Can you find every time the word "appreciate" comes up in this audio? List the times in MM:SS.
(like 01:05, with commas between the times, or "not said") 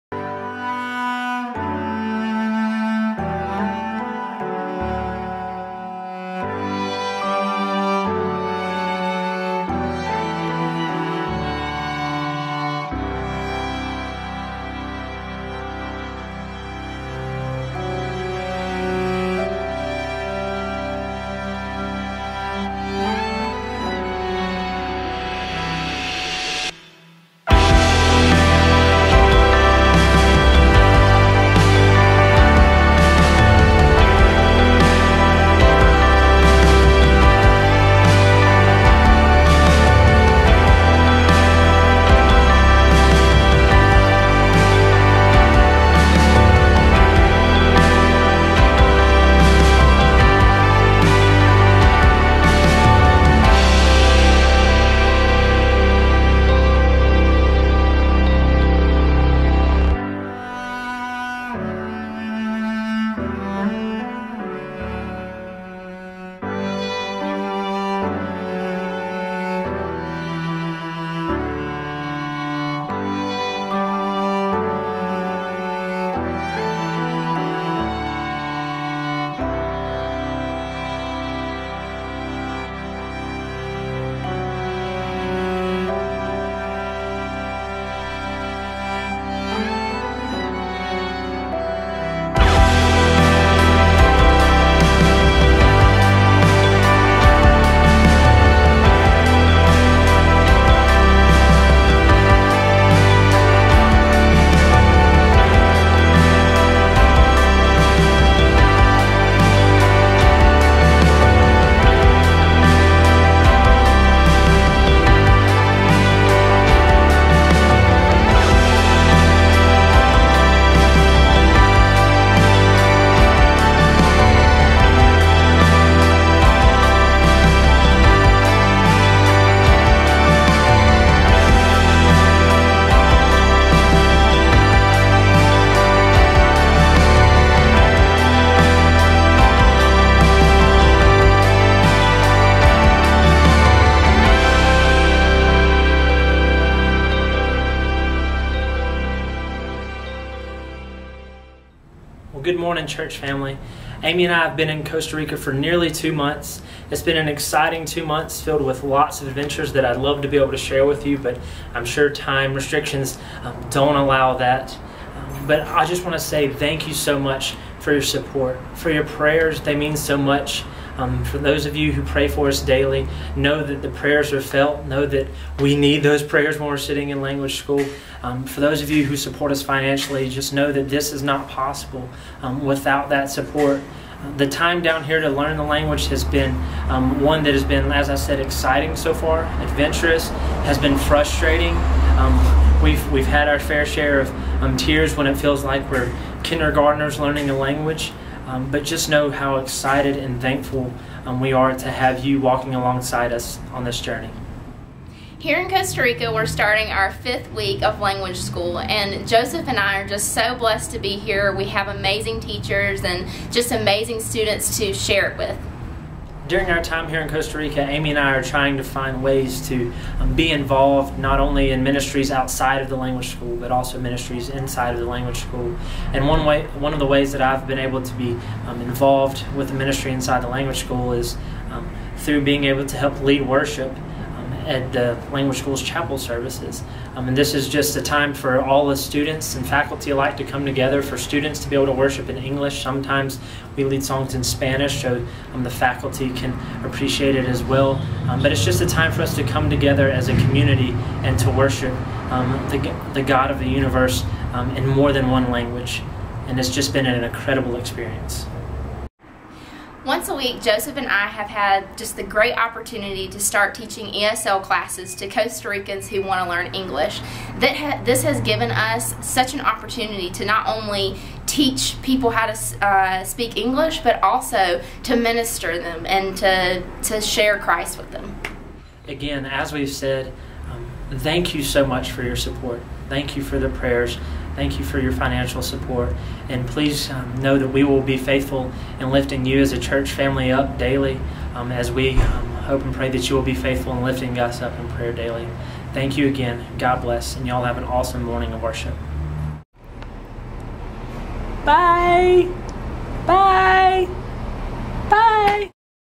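04:06.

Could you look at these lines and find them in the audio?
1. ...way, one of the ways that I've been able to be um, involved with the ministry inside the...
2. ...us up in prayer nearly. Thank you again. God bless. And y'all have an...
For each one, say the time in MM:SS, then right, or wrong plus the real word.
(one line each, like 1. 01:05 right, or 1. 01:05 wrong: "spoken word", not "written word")
1. 03:46 right
2. 04:54 wrong: "daily", not "nearly".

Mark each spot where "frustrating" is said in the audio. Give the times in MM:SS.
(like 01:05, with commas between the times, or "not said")
03:10.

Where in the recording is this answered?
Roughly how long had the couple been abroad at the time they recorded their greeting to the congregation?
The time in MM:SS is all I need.
02:35.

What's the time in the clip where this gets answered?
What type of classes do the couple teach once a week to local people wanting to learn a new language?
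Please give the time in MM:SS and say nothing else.
04:24.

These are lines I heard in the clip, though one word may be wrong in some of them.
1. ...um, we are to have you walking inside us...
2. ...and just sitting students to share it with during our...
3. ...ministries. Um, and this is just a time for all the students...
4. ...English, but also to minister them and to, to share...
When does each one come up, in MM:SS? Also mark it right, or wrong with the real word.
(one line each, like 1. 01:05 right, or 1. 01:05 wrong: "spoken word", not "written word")
1. 03:21 wrong: "alongside", not "inside"
2. 03:33 wrong: "amazing", not "sitting"
3. 03:56 wrong: "services", not "ministries"
4. 04:33 right.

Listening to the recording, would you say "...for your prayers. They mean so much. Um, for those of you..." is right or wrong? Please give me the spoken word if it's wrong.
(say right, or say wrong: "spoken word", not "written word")
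right.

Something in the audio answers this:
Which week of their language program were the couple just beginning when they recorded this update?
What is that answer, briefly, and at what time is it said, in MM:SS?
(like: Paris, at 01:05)
fifth week, at 03:27.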